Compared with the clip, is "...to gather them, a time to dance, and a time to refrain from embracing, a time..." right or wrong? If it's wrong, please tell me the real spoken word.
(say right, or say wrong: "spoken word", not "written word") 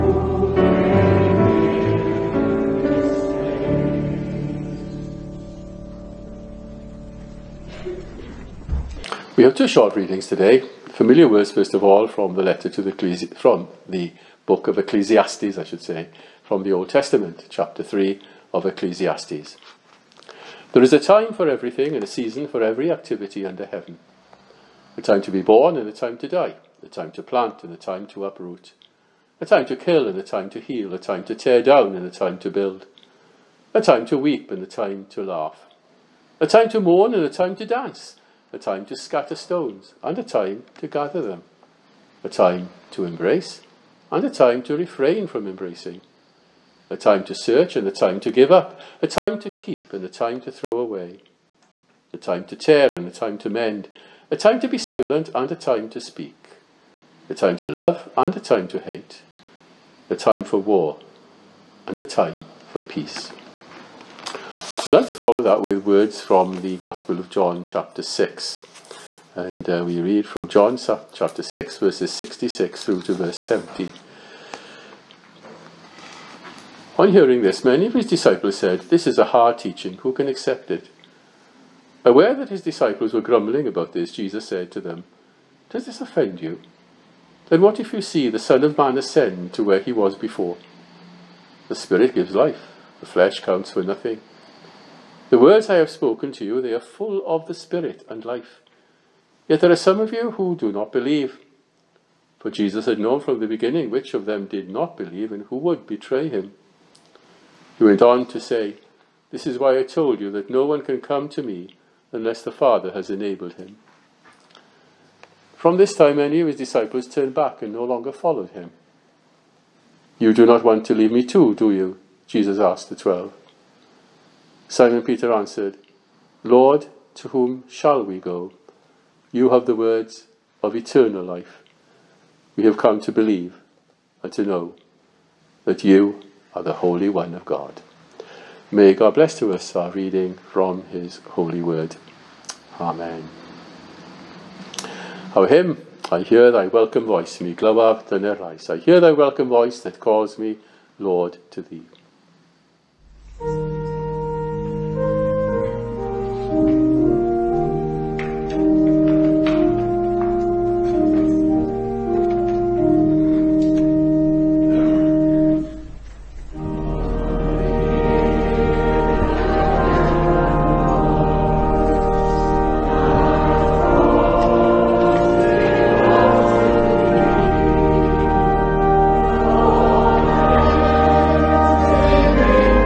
wrong: "embrace", not "dance".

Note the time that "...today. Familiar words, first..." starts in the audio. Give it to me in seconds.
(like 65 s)
10 s.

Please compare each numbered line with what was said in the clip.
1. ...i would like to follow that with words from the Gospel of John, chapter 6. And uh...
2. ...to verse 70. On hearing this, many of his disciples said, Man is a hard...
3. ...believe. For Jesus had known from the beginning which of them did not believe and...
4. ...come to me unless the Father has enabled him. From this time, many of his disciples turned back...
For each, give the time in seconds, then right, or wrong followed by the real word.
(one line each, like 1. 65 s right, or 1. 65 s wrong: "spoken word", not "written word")
1. 64 s right
2. 73 s wrong: "This", not "Man"
3. 100 s right
4. 111 s right.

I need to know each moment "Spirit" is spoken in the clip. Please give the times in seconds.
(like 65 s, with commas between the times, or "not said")
91 s, 97 s.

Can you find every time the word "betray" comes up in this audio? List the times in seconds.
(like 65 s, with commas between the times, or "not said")
105 s.